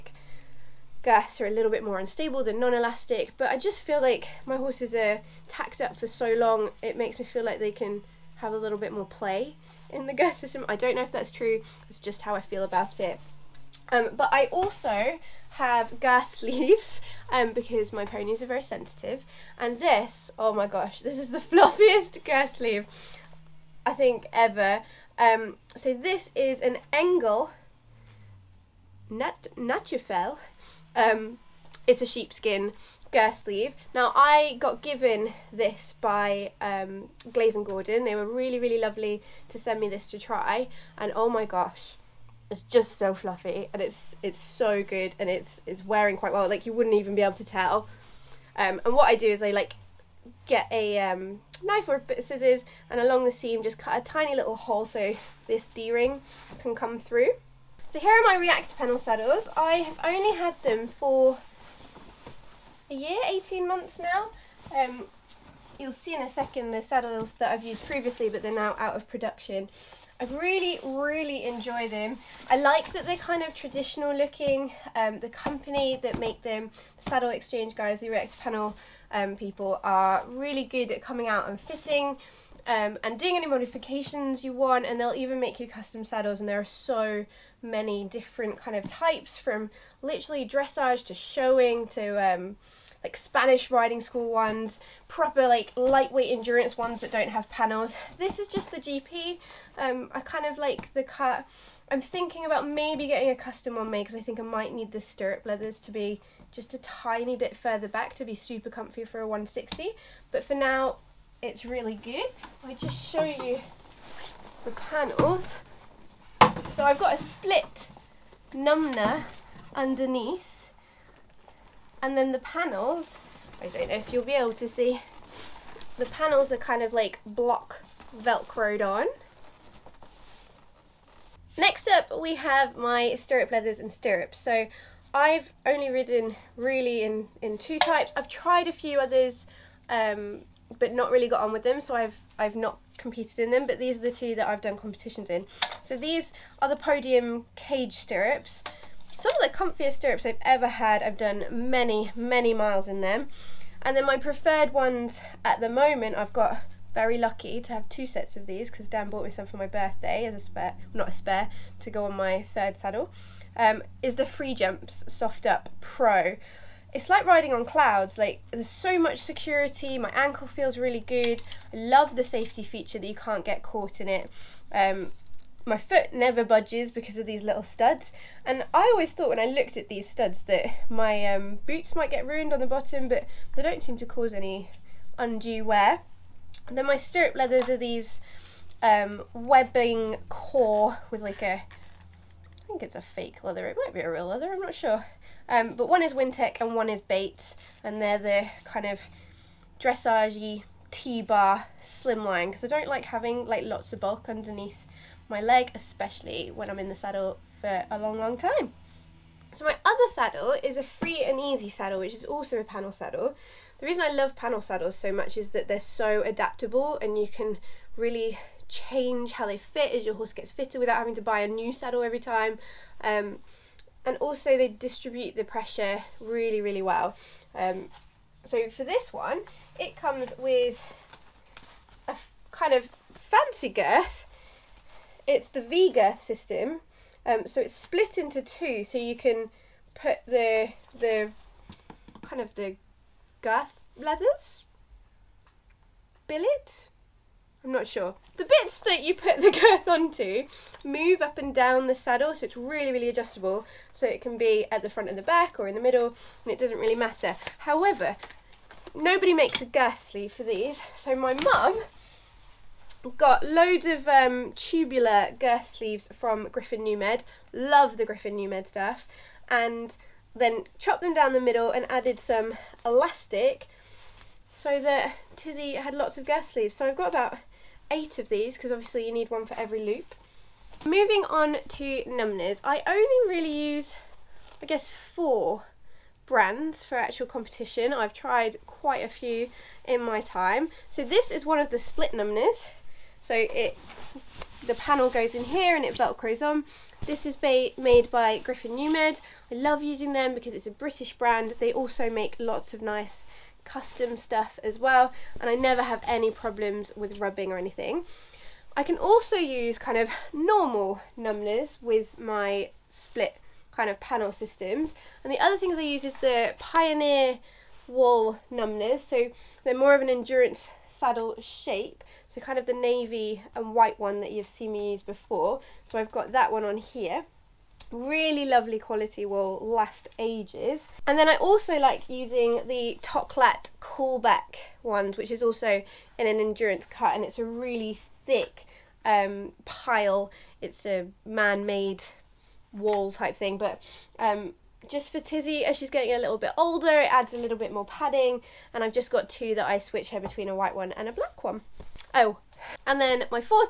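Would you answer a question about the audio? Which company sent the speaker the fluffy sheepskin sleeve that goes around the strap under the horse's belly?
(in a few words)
Glaze and Gordon.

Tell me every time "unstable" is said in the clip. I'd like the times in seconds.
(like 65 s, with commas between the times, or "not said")
1 s.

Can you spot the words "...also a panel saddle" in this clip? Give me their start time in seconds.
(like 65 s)
212 s.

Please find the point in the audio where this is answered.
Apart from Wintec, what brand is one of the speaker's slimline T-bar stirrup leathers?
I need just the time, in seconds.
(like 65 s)
197 s.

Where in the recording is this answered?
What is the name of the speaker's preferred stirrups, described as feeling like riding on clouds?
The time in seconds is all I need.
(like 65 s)
164 s.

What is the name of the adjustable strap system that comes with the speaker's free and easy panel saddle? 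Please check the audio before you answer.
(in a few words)
V girth system.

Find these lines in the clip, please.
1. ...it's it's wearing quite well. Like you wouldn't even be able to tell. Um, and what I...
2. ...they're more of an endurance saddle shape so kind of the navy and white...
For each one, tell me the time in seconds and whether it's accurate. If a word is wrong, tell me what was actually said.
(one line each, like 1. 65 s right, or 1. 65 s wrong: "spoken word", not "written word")
1. 45 s right
2. 319 s right.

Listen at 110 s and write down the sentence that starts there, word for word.
But for now, it's really good.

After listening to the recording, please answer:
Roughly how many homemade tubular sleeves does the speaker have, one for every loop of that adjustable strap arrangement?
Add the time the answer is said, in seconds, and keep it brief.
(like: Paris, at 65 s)
8, at 277 s.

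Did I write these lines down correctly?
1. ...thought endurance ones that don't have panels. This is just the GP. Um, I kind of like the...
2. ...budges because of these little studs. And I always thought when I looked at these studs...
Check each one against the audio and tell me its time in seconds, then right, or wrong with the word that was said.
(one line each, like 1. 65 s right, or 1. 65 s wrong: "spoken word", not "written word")
1. 95 s wrong: "lightweight", not "thought"
2. 176 s right.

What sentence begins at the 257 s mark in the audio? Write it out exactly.
However, nobody makes a girth sleeve for these, so my mum got loads of um, tubular girth sleeves from Griffin NuuMed.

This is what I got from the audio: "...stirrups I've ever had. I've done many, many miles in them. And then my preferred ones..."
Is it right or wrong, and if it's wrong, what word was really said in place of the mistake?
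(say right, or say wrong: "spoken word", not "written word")
right.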